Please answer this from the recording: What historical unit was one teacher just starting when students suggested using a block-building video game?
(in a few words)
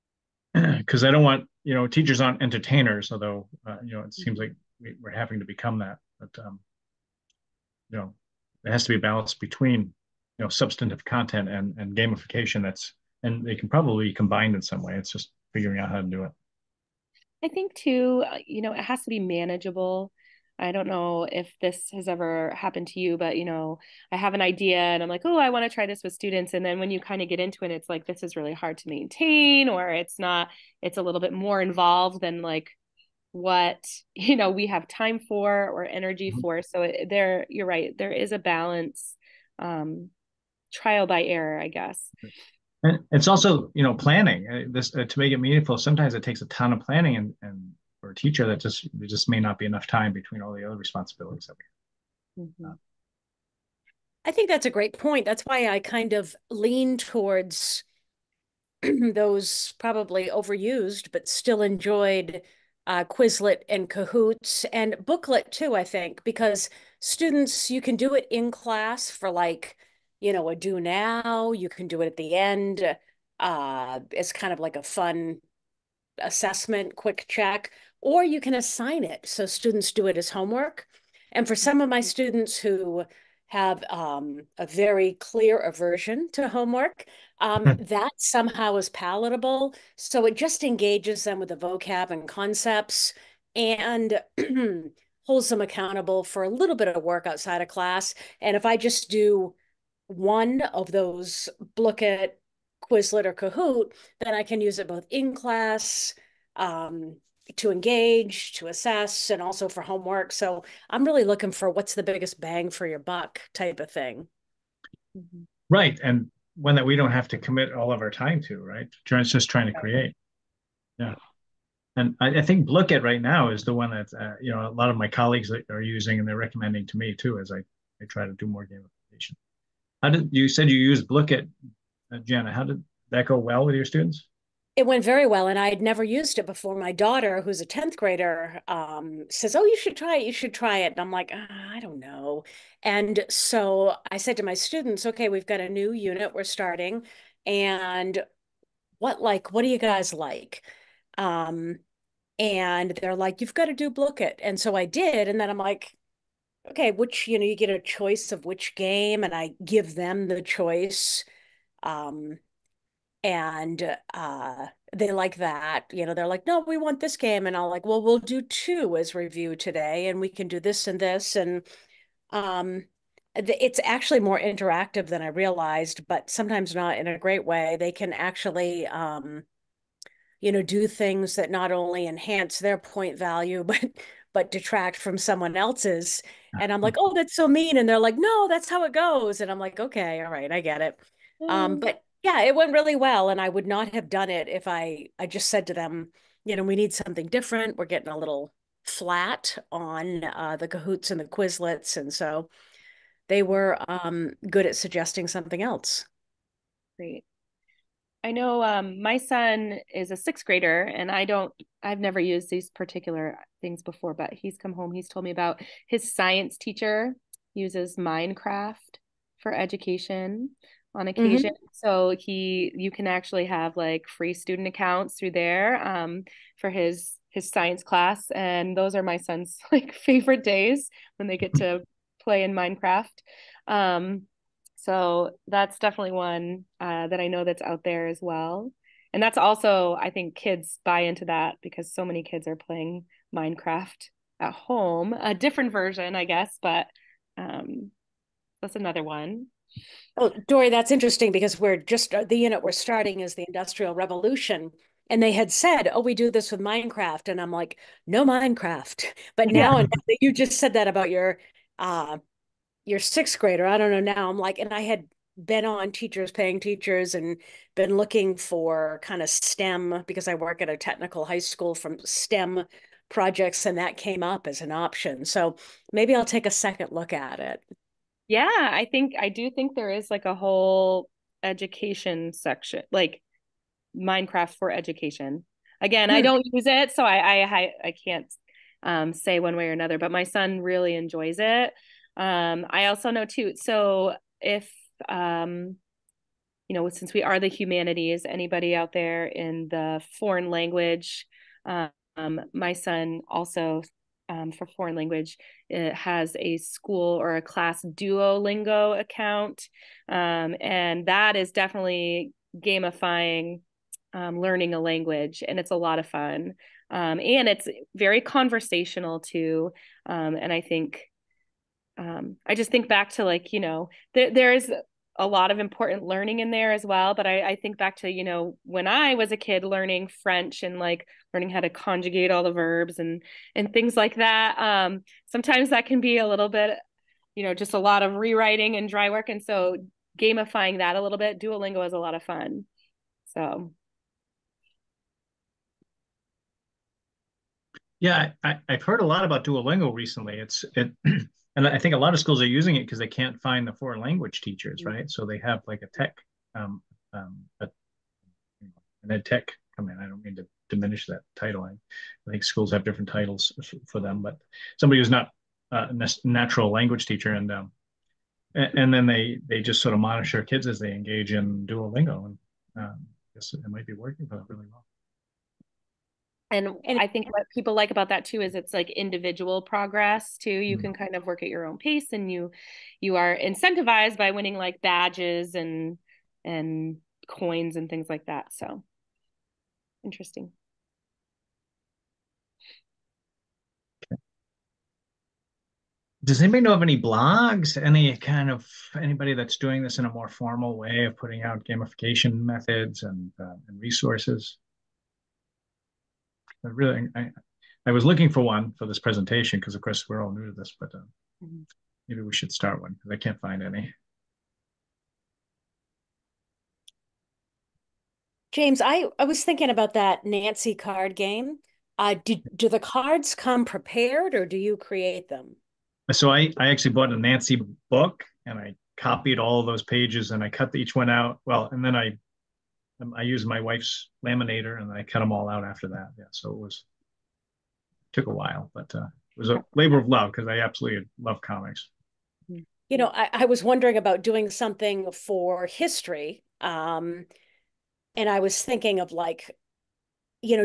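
Industrial Revolution.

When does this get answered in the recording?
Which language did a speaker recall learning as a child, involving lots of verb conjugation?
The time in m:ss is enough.
5:30.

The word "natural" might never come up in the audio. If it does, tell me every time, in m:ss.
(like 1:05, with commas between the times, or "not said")
6:06.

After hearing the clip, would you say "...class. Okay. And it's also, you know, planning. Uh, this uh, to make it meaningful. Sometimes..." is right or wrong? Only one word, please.
wrong.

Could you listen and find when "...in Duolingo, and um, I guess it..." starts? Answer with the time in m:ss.
6:11.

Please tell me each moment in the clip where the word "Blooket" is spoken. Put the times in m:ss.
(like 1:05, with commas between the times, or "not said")
2:02, 2:11, 2:33.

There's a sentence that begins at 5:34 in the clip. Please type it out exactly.
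Um, sometimes that can be a little bit, you know, just a lot of rewriting and dry work.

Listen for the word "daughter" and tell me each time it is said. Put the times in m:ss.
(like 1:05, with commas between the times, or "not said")
2:16.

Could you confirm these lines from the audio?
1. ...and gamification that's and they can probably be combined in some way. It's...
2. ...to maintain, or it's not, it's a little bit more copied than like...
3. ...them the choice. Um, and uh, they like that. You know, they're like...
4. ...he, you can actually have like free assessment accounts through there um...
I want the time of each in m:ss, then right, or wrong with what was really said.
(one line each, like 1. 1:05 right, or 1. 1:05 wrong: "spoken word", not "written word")
1. 0:11 right
2. 0:28 wrong: "involved", not "copied"
3. 2:39 right
4. 3:42 wrong: "student", not "assessment".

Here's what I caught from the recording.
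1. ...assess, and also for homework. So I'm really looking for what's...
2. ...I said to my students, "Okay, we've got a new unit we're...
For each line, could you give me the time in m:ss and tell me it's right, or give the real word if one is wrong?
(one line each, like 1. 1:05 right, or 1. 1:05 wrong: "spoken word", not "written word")
1. 1:48 right
2. 2:24 right.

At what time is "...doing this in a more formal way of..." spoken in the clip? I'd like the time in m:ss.
6:39.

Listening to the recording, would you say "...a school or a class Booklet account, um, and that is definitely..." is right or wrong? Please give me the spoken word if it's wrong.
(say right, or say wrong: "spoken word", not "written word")
wrong: "Duolingo", not "Booklet".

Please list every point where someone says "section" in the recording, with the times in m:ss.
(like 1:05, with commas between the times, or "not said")
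4:42.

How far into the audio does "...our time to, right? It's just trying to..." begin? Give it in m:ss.
1:58.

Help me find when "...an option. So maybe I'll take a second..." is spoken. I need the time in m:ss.
4:34.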